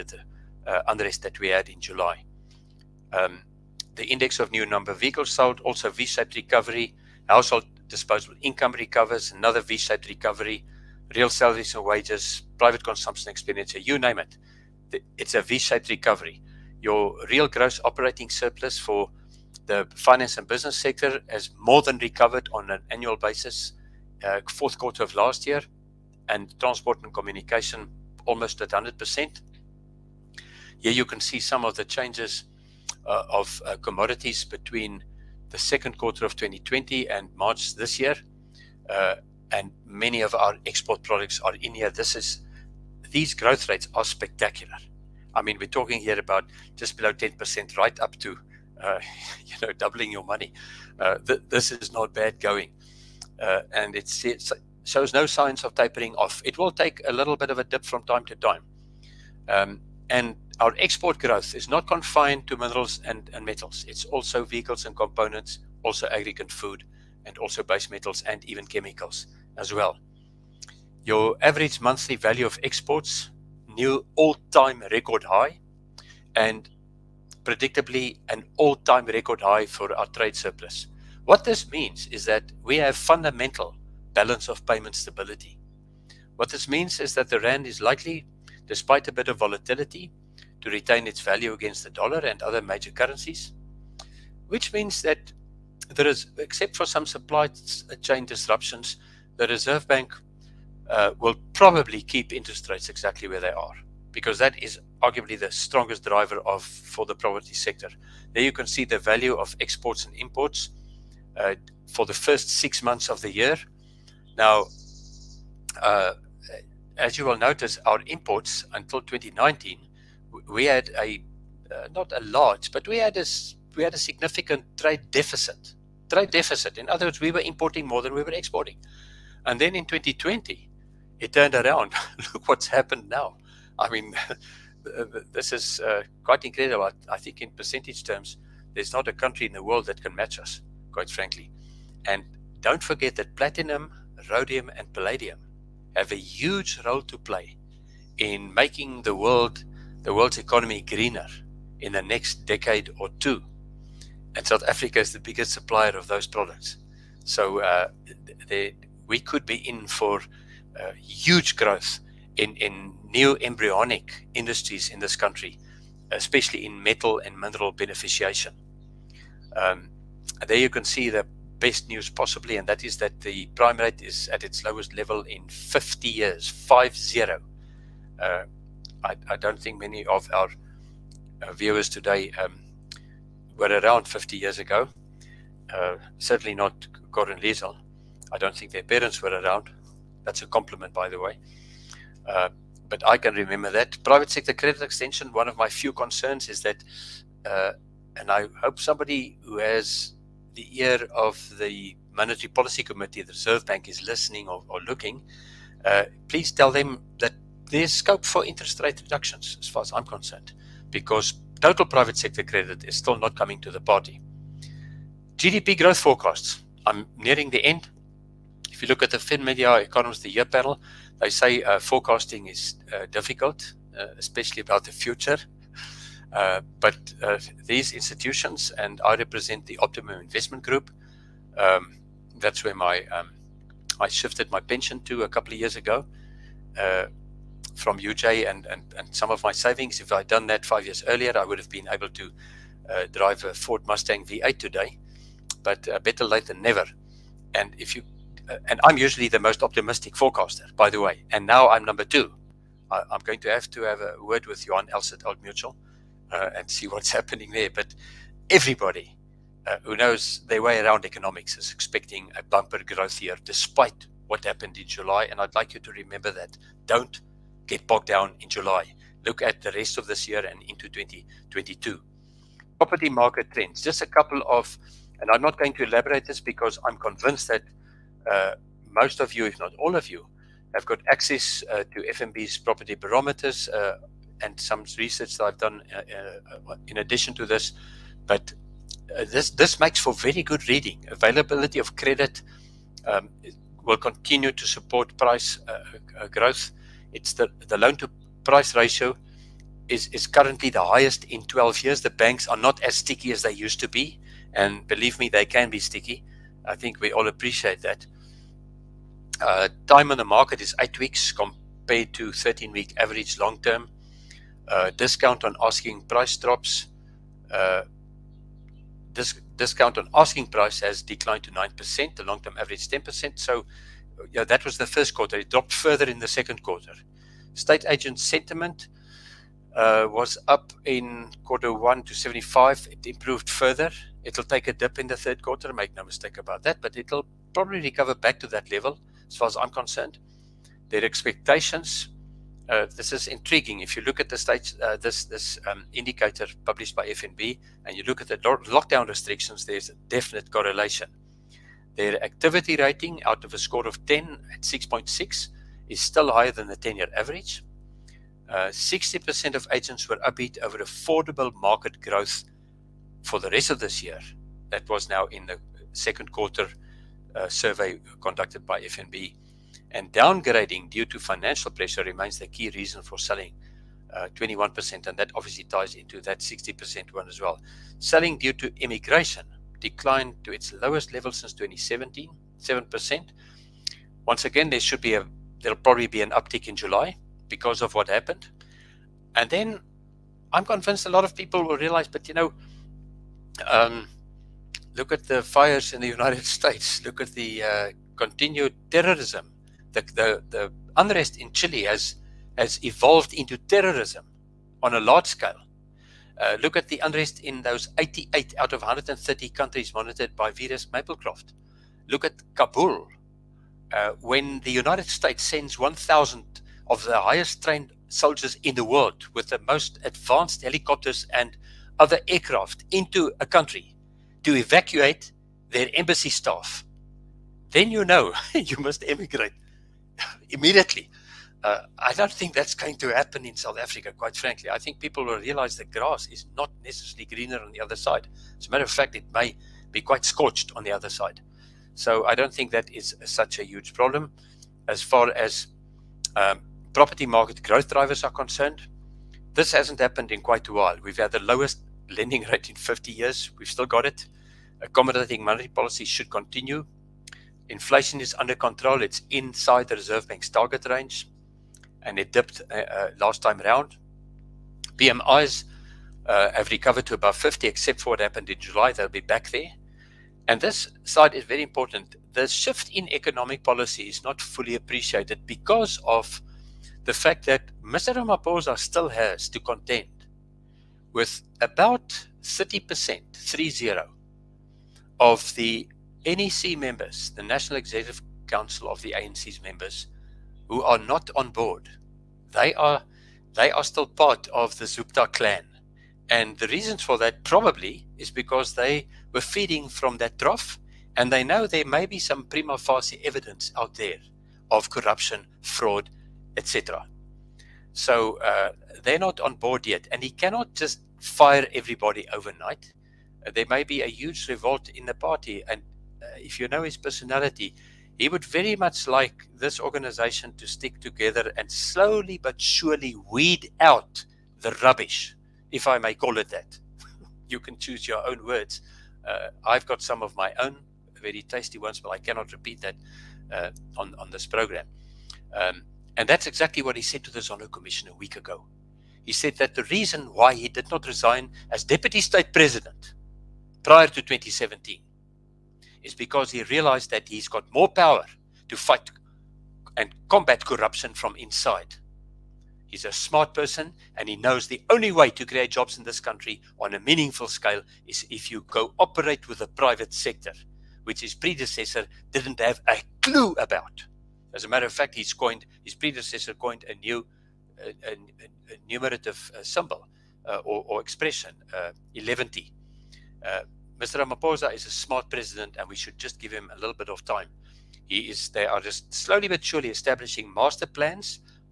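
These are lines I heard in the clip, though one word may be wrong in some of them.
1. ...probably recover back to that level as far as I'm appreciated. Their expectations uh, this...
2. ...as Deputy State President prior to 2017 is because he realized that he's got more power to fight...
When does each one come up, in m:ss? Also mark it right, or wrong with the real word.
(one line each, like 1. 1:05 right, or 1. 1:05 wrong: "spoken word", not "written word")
1. 5:37 wrong: "concerned", not "appreciated"
2. 9:01 right.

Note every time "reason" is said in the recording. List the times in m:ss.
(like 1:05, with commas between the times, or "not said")
6:12, 8:16, 8:59.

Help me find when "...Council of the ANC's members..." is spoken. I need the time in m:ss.
8:08.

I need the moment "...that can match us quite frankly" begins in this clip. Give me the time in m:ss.
2:19.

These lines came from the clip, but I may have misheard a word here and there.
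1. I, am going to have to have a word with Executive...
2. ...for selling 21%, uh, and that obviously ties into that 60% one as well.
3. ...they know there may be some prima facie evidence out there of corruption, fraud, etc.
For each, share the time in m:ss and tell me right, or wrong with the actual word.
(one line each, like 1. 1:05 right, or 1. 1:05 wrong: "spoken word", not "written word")
1. 4:12 wrong: "Johan", not "Executive"
2. 6:13 right
3. 8:21 right.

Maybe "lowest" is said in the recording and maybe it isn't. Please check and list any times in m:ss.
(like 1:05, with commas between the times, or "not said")
2:54, 6:20, 7:31.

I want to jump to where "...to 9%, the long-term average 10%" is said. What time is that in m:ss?
5:21.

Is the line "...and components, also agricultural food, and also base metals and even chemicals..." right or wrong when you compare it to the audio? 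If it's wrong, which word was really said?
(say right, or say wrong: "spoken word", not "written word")
right.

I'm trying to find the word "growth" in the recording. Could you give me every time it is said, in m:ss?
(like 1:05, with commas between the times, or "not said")
0:43, 1:01, 2:41, 3:35, 4:22, 4:56, 6:02, 7:27.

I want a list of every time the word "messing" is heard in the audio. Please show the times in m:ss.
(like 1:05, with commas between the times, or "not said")
not said.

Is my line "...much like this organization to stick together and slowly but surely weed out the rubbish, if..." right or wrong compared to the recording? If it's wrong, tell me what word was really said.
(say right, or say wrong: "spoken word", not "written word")
right.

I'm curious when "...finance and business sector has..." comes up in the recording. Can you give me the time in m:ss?
0:19.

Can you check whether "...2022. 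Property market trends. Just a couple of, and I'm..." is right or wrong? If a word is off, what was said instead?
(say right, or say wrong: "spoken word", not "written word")
right.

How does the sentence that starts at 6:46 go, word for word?
Uh, look at the unrest in those 88 out of 130 countries monitored by Verisk Maplecroft.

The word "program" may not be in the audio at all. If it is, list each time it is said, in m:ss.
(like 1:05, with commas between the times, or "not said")
8:54.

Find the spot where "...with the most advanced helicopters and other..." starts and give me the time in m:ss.
6:59.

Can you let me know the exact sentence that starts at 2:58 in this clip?
Uh, I, I, don't think many of our uh, viewers today um, were around 50 years ago.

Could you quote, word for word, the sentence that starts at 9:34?
Ramaphosa is a smart president, and we should just give him a little bit of time.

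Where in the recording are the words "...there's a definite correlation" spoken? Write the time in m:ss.
5:49.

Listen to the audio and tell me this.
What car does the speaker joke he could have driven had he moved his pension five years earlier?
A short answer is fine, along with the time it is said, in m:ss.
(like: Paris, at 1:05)
Ford Mustang V8, at 4:03.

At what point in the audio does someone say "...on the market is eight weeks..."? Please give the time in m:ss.
5:10.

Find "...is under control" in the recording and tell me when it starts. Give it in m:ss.
7:38.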